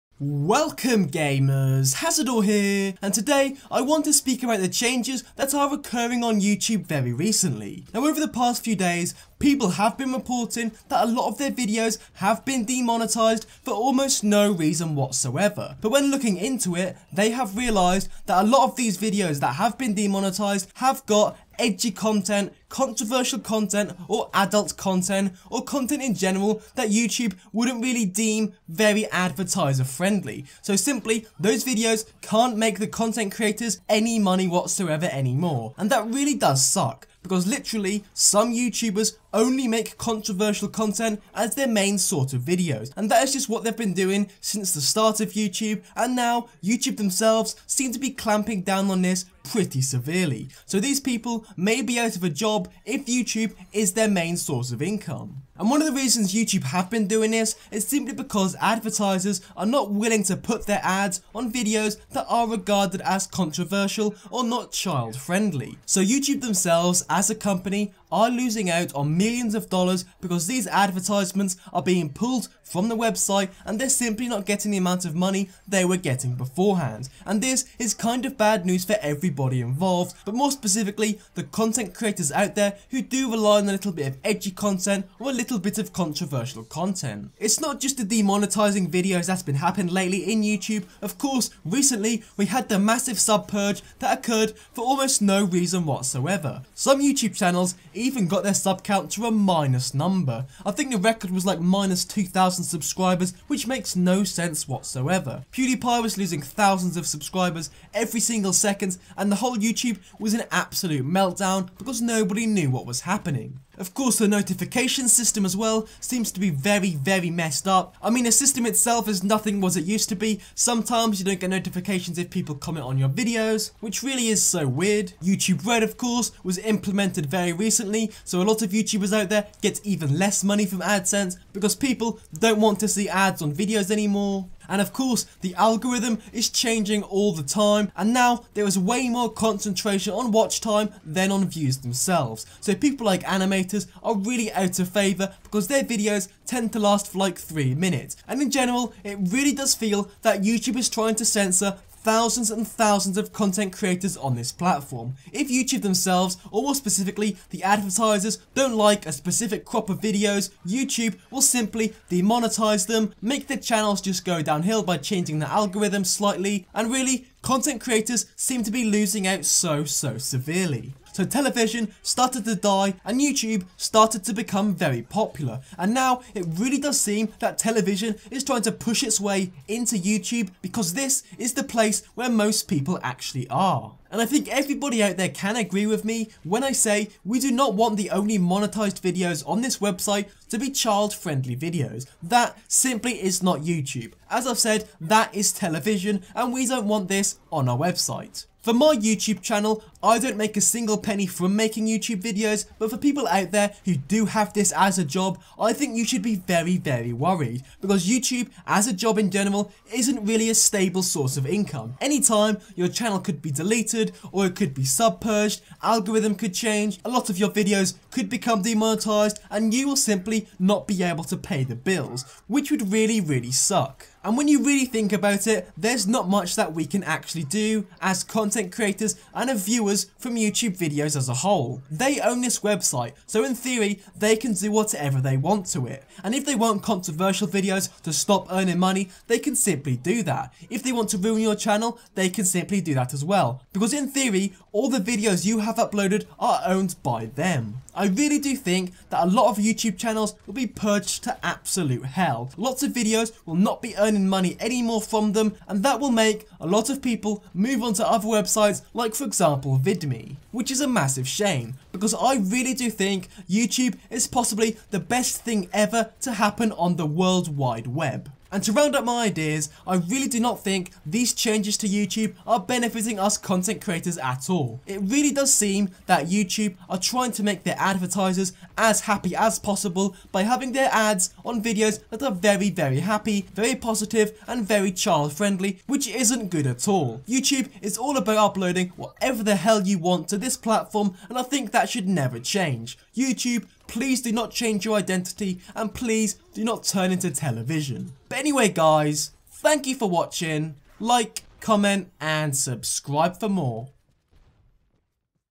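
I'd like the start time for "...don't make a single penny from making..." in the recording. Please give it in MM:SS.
03:20.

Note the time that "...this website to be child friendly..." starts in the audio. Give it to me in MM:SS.
03:09.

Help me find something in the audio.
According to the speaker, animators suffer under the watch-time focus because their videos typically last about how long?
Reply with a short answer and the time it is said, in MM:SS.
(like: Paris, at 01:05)
3 minutes, at 02:27.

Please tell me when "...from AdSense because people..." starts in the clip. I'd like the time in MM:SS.
02:10.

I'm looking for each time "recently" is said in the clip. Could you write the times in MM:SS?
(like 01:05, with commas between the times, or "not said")
00:07, 01:31, 02:07.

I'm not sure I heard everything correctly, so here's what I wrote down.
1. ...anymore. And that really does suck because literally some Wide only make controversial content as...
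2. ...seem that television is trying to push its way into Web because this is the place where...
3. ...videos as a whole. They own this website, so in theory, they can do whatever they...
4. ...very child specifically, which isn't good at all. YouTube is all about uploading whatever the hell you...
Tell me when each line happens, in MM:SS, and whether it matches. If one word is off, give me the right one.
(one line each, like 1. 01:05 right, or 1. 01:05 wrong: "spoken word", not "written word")
1. 00:35 wrong: "YouTubers", not "Wide"
2. 02:56 wrong: "YouTube", not "Web"
3. 03:50 right
4. 04:44 wrong: "friendly", not "specifically".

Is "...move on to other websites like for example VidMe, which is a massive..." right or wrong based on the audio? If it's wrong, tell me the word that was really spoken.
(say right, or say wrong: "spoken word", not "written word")
right.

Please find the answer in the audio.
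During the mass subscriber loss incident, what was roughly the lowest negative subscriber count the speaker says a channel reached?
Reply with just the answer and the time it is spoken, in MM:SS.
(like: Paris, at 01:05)
-2,000, at 01:41.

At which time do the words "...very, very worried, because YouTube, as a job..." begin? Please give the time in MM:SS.
03:26.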